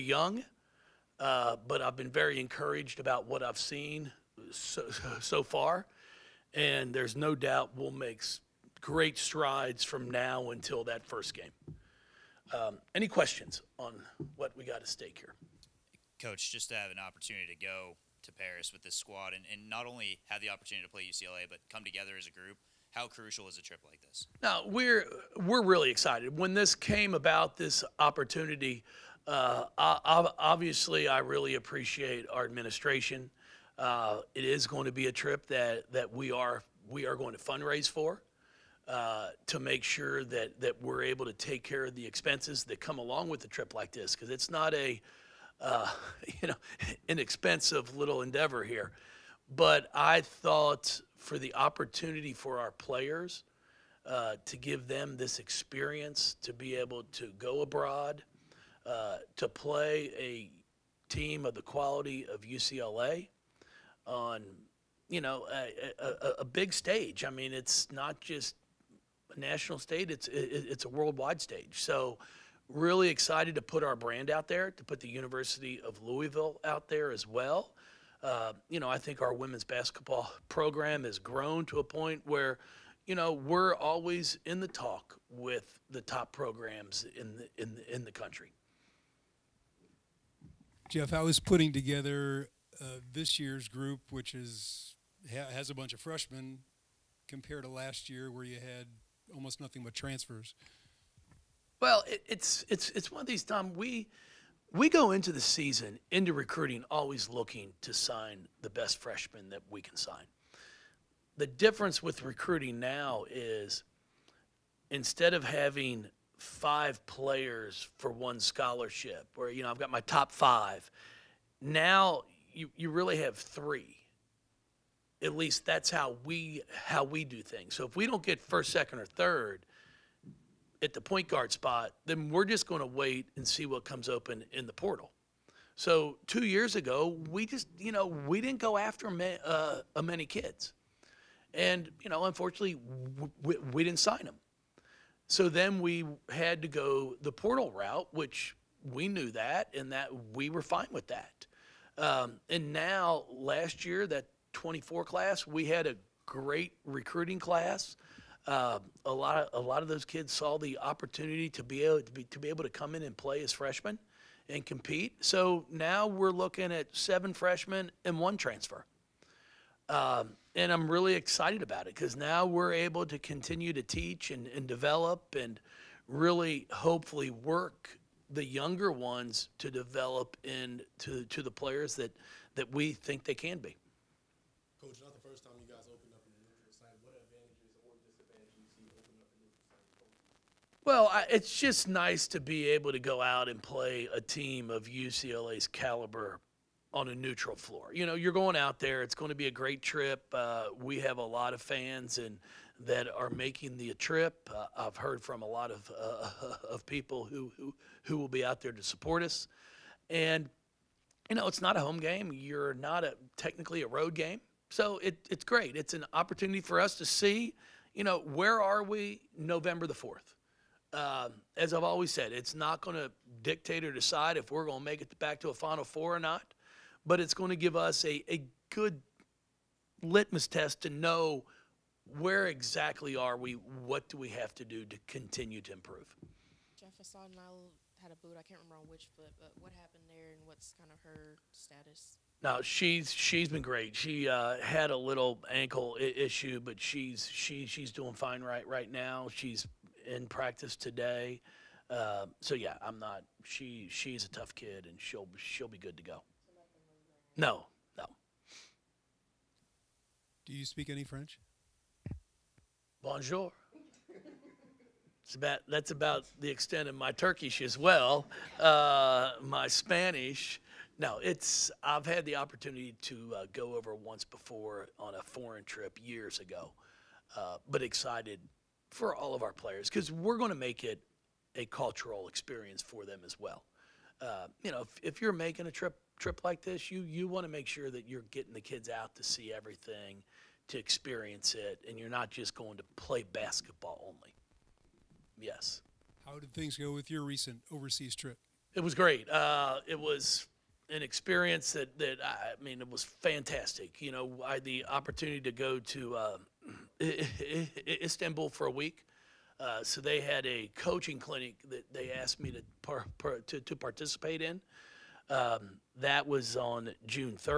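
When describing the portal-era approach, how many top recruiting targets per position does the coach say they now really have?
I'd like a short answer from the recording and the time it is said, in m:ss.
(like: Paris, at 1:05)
3, at 2:03.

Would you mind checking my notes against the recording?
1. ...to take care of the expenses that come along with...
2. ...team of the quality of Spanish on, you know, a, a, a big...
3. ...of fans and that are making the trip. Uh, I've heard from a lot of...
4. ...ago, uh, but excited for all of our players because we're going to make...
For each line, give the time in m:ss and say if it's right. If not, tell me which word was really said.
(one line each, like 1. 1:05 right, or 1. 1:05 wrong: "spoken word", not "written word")
1. 0:41 right
2. 1:01 wrong: "UCLA", not "Spanish"
3. 3:21 right
4. 4:36 right.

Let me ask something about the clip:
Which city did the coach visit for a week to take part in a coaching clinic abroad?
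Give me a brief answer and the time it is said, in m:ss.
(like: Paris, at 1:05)
Istanbul, at 5:07.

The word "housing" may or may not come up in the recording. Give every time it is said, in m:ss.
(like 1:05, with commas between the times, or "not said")
not said.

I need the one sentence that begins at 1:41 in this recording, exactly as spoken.
Well, it, it's it's it's one of these Tom.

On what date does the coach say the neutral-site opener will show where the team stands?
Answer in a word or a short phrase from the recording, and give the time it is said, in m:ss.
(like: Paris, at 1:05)
November 4, at 3:39.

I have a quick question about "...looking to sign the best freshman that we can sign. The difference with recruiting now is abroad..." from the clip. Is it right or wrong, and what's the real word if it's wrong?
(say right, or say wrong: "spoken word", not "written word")
wrong: "instead", not "abroad".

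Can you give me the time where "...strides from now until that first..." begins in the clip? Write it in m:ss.
0:09.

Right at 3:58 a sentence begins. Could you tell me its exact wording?
I can't remember on which foot, but what happened there and what's kind of her status?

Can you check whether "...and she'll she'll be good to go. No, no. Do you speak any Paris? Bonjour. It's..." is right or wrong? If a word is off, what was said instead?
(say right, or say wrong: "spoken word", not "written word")
wrong: "French", not "Paris".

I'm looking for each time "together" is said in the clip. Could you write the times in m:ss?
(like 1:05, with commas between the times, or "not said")
0:21, 1:31.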